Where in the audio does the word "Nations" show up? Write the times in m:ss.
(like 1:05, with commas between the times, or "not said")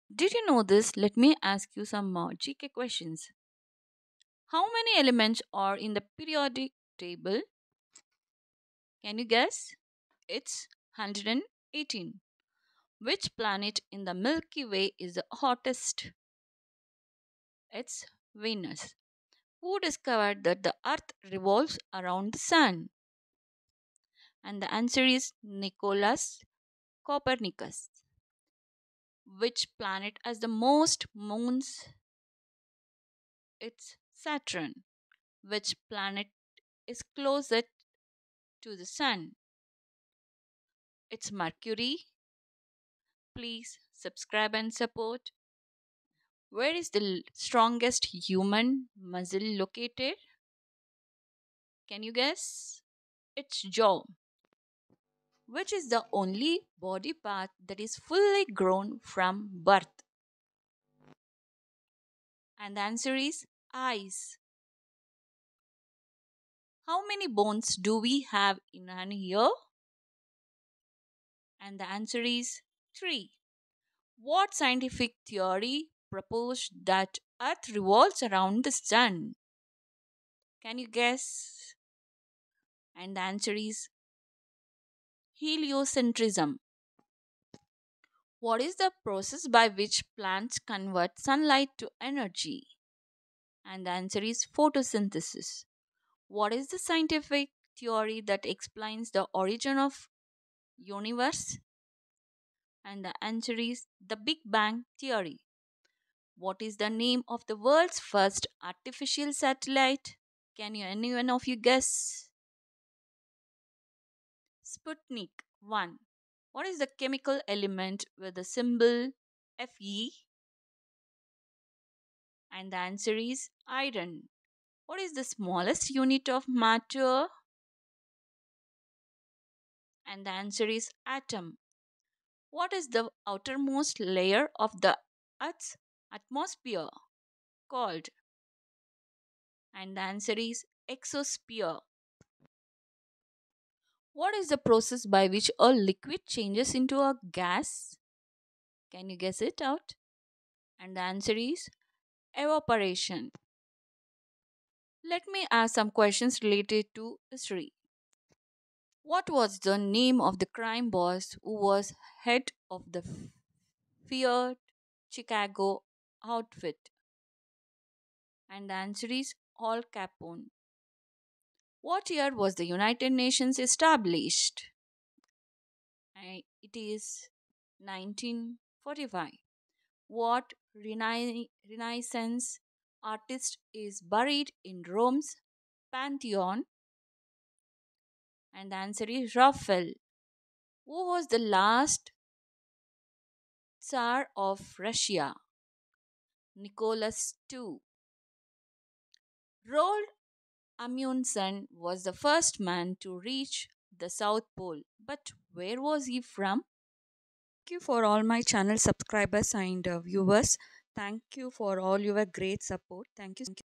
2:53.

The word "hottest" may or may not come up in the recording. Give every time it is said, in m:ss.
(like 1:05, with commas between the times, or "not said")
0:15.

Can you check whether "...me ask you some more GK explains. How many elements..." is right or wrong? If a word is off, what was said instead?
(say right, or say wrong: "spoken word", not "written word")
wrong: "questions", not "explains".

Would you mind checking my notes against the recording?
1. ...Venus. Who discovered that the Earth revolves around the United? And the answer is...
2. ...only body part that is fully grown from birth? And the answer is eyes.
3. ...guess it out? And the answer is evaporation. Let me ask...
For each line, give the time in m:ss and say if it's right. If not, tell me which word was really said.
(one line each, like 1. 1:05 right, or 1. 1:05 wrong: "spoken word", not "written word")
1. 0:18 wrong: "Sun", not "United"
2. 0:56 right
3. 2:29 right.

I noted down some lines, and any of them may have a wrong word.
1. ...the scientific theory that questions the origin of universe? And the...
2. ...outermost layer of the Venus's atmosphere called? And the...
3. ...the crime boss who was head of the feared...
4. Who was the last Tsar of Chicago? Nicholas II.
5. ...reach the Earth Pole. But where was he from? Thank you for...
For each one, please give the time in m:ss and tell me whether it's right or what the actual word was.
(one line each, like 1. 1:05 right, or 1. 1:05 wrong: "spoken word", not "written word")
1. 1:36 wrong: "explains", not "questions"
2. 2:13 wrong: "Earth", not "Venus"
3. 2:40 right
4. 3:10 wrong: "Russia", not "Chicago"
5. 3:23 wrong: "South", not "Earth".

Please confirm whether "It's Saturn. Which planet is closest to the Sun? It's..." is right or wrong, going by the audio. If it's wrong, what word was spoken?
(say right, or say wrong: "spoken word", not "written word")
right.